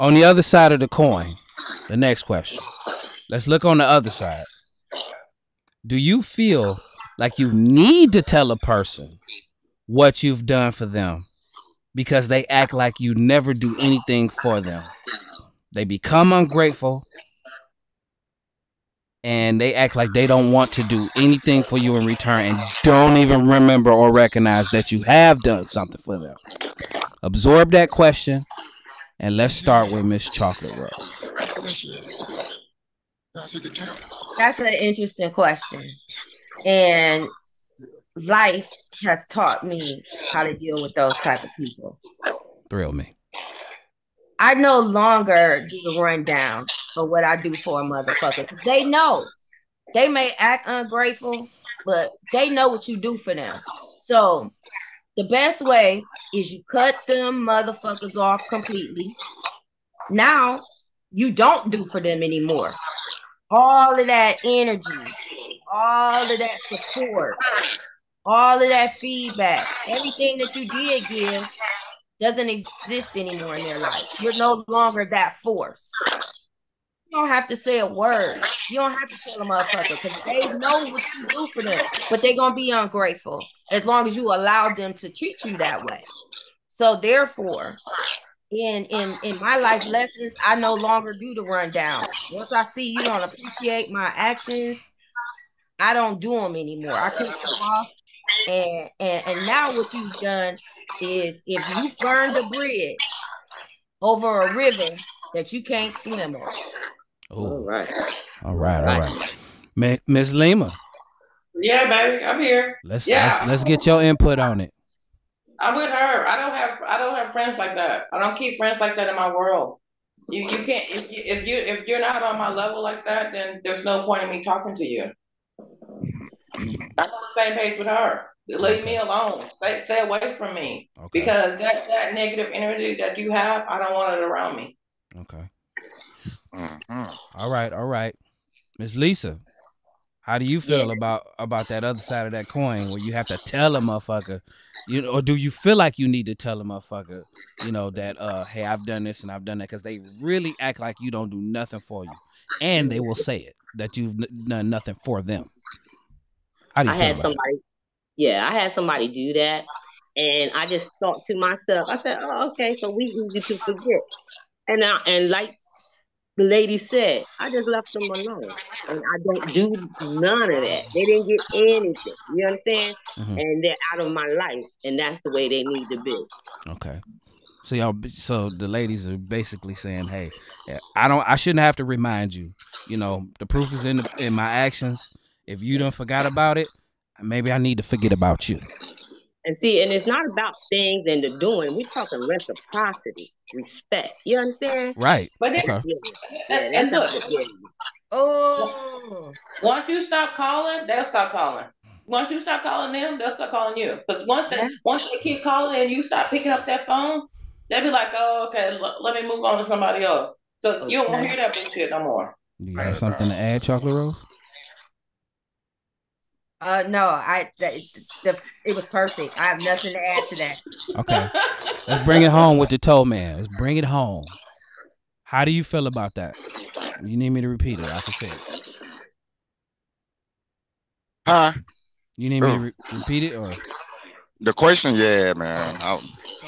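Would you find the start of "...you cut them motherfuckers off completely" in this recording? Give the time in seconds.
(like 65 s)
56 s.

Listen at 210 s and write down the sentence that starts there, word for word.
you don't hear that bullshit no more.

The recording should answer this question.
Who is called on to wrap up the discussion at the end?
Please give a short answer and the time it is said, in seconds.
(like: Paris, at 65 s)
the Towman, at 222 s.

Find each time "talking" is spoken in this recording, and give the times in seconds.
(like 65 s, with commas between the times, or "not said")
124 s, 191 s.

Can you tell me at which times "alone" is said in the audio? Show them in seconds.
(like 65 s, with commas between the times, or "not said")
128 s, 168 s.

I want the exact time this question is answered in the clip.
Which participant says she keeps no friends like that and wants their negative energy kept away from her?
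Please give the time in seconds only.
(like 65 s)
110 s.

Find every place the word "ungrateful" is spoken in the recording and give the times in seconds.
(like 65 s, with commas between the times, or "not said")
16 s, 50 s, 82 s.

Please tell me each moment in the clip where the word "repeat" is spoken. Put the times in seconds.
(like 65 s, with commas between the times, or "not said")
227 s, 232 s.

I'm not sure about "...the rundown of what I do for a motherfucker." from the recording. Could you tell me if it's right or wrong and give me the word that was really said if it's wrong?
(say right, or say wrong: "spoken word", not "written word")
right.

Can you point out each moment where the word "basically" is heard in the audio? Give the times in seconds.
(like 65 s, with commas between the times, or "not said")
179 s.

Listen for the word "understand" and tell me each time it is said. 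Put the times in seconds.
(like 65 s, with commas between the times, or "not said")
172 s, 194 s.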